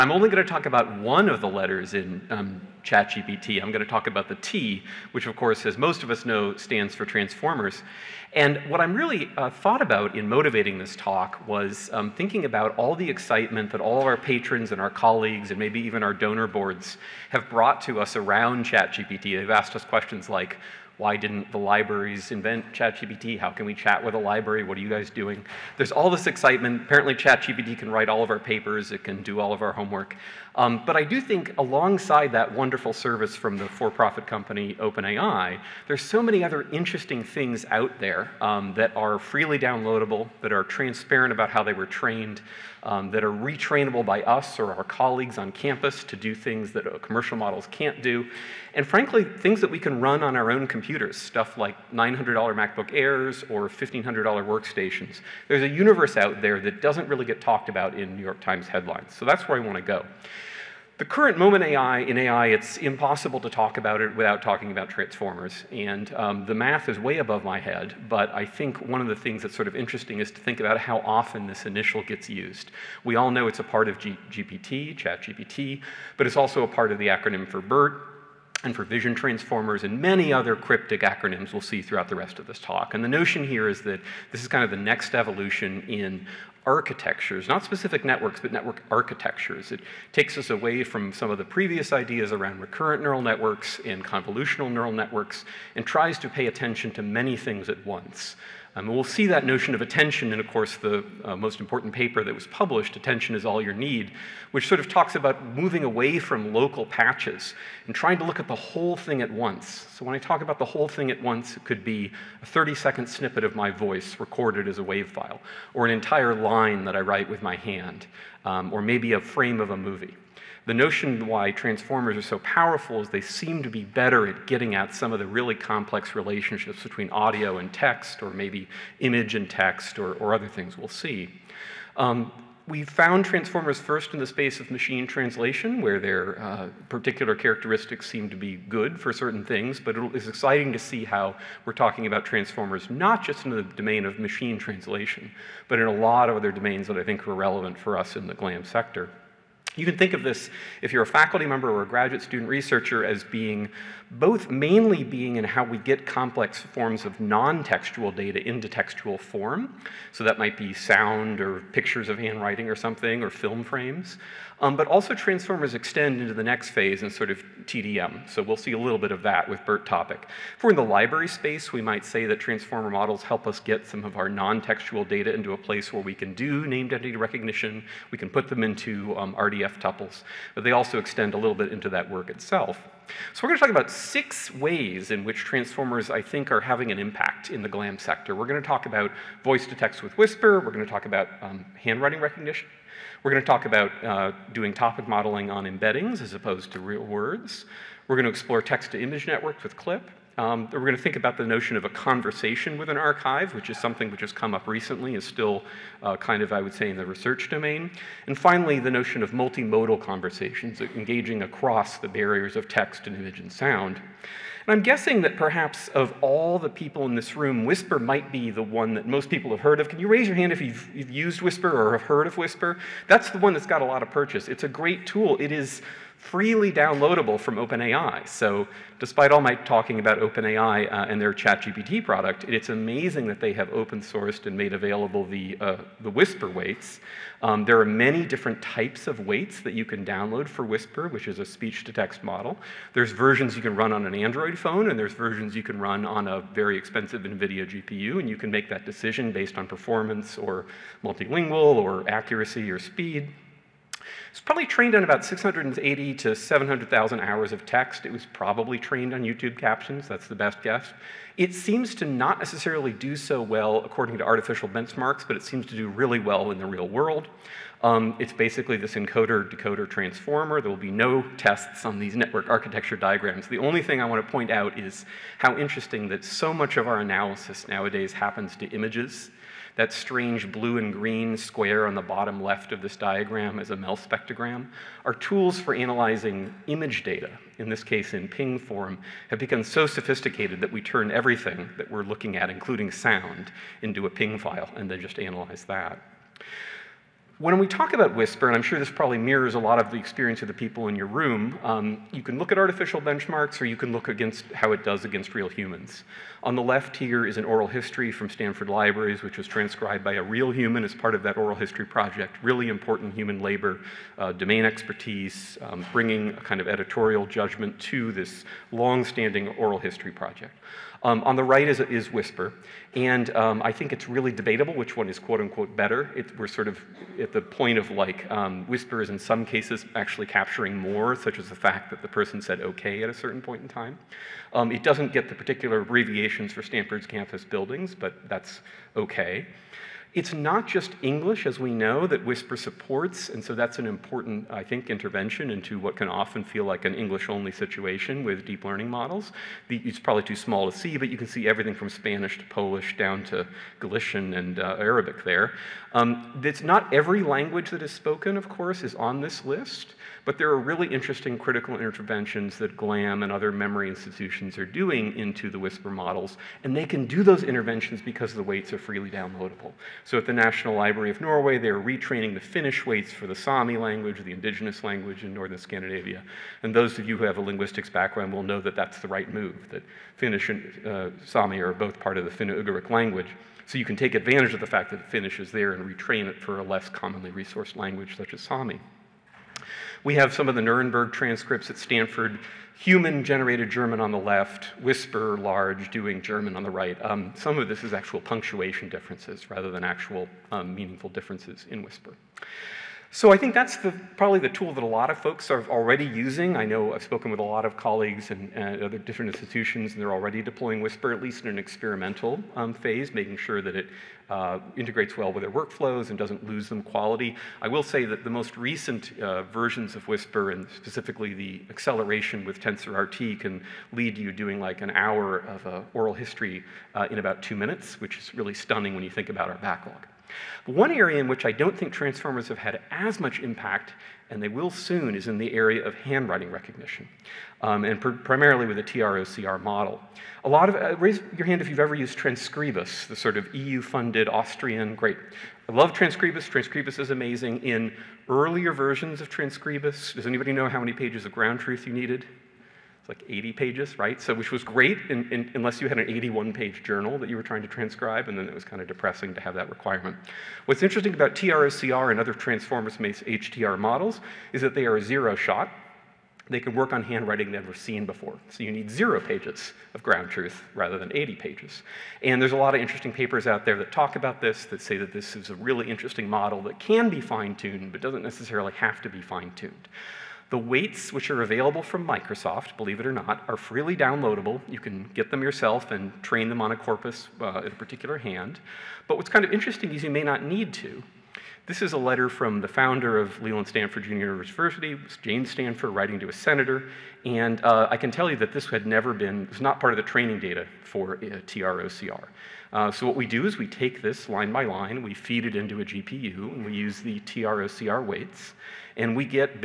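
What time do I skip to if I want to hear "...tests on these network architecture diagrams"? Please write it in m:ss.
4:31.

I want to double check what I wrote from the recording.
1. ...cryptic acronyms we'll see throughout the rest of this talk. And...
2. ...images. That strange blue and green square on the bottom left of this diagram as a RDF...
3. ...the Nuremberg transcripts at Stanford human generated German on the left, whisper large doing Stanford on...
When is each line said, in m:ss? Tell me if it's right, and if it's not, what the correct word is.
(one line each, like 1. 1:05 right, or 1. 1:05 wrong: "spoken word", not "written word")
1. 1:20 right
2. 4:38 wrong: "MEL", not "RDF"
3. 6:30 wrong: "German", not "Stanford".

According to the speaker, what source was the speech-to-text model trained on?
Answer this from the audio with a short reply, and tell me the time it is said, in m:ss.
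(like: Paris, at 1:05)
YouTube captions, at 4:19.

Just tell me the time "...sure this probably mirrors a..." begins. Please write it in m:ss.
4:58.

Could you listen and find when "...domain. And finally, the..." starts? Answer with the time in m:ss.
3:27.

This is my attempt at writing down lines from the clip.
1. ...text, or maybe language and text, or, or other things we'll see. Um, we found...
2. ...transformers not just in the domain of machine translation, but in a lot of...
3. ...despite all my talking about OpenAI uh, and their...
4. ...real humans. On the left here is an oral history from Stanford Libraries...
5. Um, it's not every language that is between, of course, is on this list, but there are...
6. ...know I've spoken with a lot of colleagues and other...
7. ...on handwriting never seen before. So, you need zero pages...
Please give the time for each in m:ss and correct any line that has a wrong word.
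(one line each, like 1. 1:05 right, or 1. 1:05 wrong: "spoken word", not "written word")
1. 2:07 wrong: "image", not "language"
2. 2:22 right
3. 3:48 right
4. 5:05 right
5. 5:55 wrong: "spoken", not "between"
6. 6:46 right
7. 7:46 right.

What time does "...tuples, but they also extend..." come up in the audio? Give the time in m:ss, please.
2:59.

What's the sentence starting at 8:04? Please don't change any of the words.
You can get them yourself and train them on a corpus uh, in a particular hand.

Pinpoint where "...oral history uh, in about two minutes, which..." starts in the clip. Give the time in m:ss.
7:05.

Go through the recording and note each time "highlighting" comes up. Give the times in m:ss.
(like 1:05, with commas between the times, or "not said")
not said.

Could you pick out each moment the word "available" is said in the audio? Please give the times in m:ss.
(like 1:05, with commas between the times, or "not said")
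3:54, 8:01.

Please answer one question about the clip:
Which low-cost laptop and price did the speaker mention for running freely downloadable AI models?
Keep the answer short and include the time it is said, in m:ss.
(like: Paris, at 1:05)
$900 MacBook Airs, at 0:51.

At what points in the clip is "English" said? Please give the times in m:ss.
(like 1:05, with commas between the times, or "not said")
5:41, 5:46.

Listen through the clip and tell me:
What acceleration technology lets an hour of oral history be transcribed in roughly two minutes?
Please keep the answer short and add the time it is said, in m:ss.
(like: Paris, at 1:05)
TensorRT, at 7:02.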